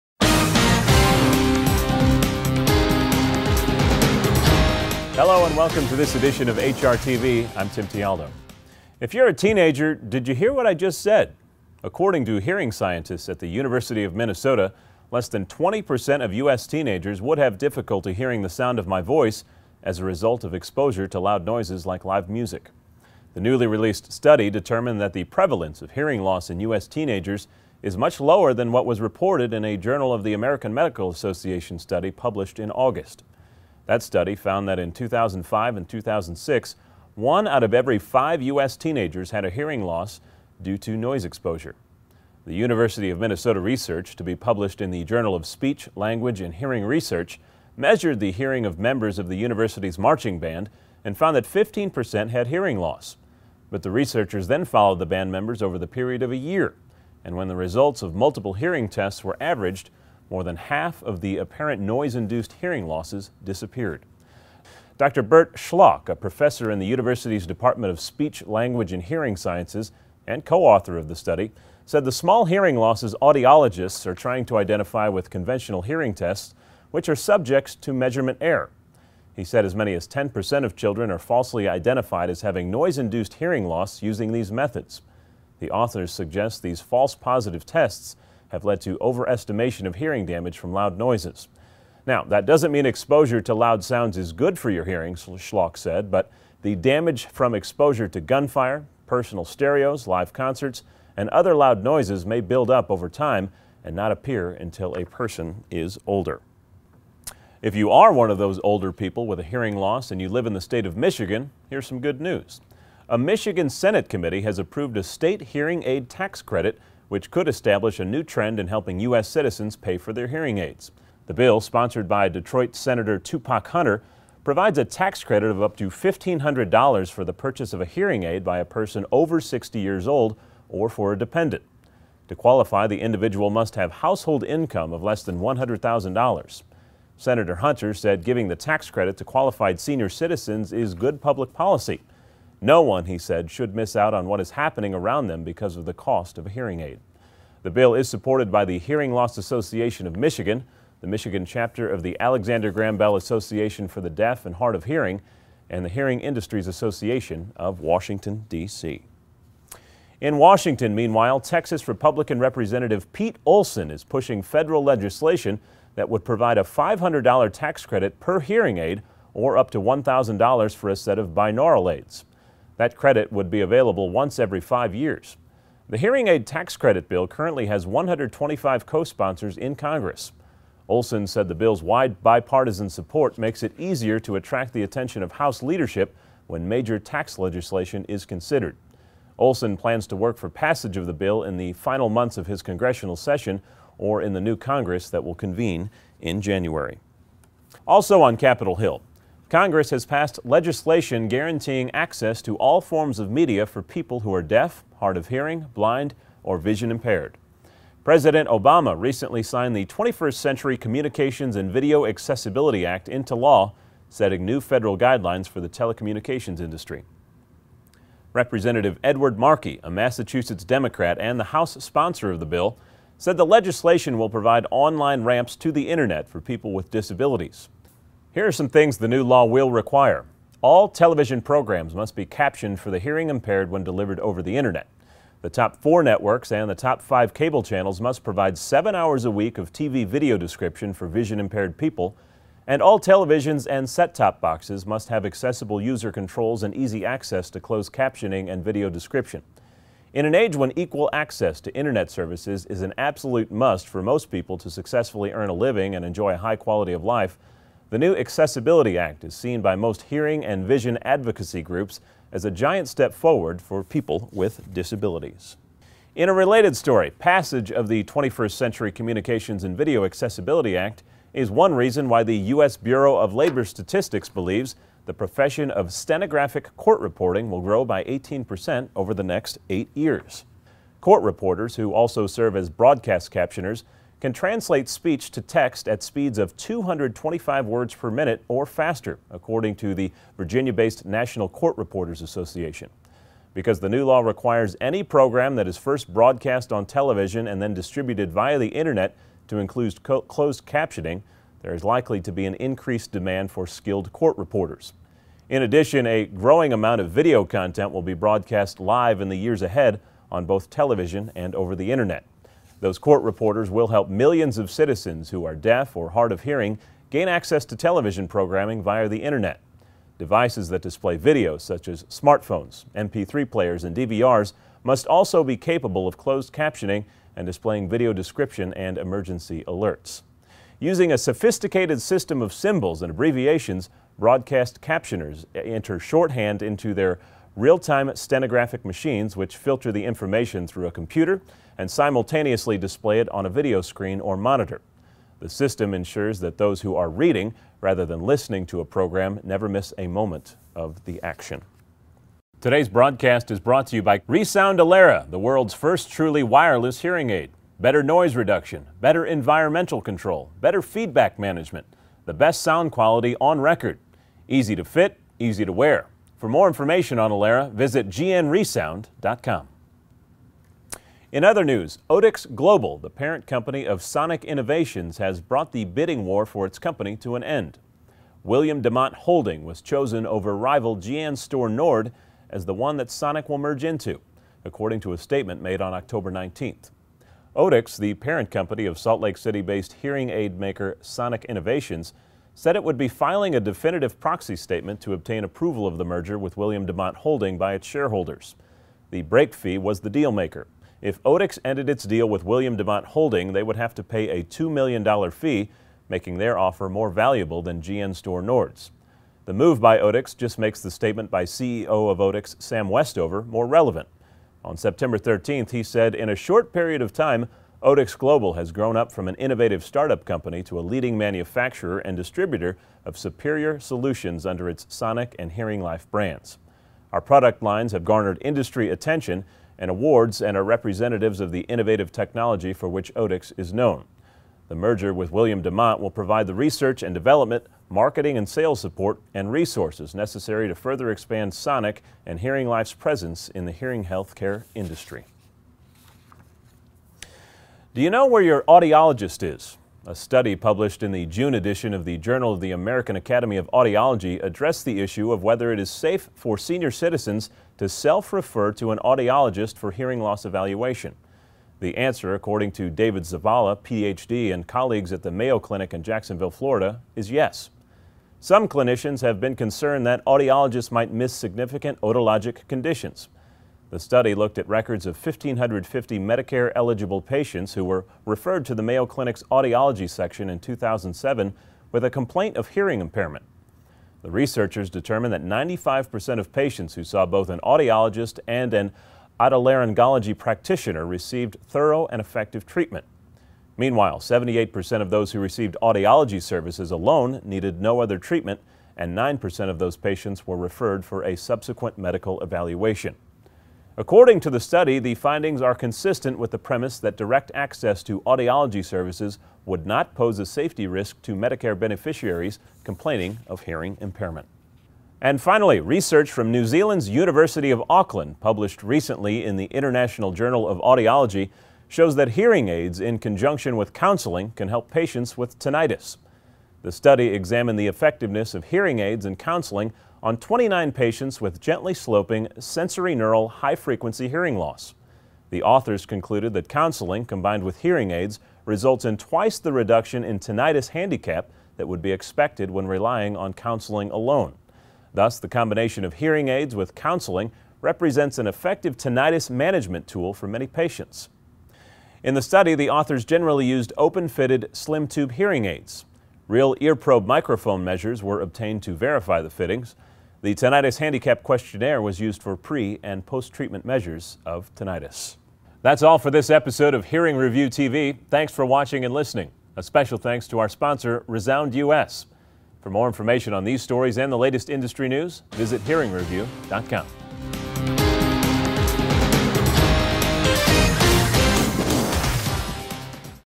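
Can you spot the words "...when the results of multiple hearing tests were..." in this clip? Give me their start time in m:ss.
0:57.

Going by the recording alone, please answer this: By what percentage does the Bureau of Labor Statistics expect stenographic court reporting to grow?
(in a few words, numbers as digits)
18%.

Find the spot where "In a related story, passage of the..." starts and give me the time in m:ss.
4:26.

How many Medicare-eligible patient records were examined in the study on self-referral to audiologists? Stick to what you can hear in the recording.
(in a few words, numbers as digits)
1,550.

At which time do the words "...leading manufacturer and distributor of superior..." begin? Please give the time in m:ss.
7:00.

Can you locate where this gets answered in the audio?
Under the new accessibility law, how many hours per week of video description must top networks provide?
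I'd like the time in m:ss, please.
3:58.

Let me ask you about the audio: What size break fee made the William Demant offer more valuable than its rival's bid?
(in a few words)
$2 million.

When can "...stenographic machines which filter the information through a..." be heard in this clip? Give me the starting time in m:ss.
5:38.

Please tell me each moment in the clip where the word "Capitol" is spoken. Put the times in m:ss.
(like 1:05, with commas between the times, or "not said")
3:18.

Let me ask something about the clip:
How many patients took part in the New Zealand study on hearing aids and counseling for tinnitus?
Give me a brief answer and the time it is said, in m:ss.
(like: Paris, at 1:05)
29, at 8:50.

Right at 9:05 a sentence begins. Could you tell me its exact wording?
Thus, the combination of hearing aids with counseling represents an effective tinnitus management tool for many patients.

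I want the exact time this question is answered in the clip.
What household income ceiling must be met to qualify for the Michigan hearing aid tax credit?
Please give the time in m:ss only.
2:15.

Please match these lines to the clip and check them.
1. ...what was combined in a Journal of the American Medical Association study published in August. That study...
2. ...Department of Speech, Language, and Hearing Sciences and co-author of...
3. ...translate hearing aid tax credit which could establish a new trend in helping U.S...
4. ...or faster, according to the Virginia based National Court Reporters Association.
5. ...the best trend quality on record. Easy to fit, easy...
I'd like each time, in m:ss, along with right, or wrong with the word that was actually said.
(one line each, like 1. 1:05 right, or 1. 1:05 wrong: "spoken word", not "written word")
1. 0:28 wrong: "reported", not "combined"
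2. 1:07 right
3. 1:55 wrong: "state", not "translate"
4. 4:48 right
5. 6:02 wrong: "sound", not "trend".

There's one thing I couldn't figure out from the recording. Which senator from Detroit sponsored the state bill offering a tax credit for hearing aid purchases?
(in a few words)
Tupac Hunter.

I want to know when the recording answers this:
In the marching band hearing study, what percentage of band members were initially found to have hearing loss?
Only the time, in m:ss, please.
0:51.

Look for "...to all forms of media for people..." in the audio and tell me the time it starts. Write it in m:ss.
3:22.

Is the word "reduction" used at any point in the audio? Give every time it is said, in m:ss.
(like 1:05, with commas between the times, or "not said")
5:58, 8:59.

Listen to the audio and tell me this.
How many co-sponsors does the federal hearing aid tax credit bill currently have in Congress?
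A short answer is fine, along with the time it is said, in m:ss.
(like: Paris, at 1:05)
125, at 2:57.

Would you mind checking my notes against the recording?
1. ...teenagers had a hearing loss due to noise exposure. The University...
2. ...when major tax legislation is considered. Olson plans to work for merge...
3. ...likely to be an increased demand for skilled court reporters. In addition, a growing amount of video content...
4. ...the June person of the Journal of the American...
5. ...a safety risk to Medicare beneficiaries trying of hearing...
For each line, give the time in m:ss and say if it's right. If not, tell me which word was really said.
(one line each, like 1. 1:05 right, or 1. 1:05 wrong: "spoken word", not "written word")
1. 0:38 right
2. 3:06 wrong: "passage", not "merge"
3. 5:01 right
4. 7:31 wrong: "edition", not "person"
5. 8:30 wrong: "complaining", not "trying".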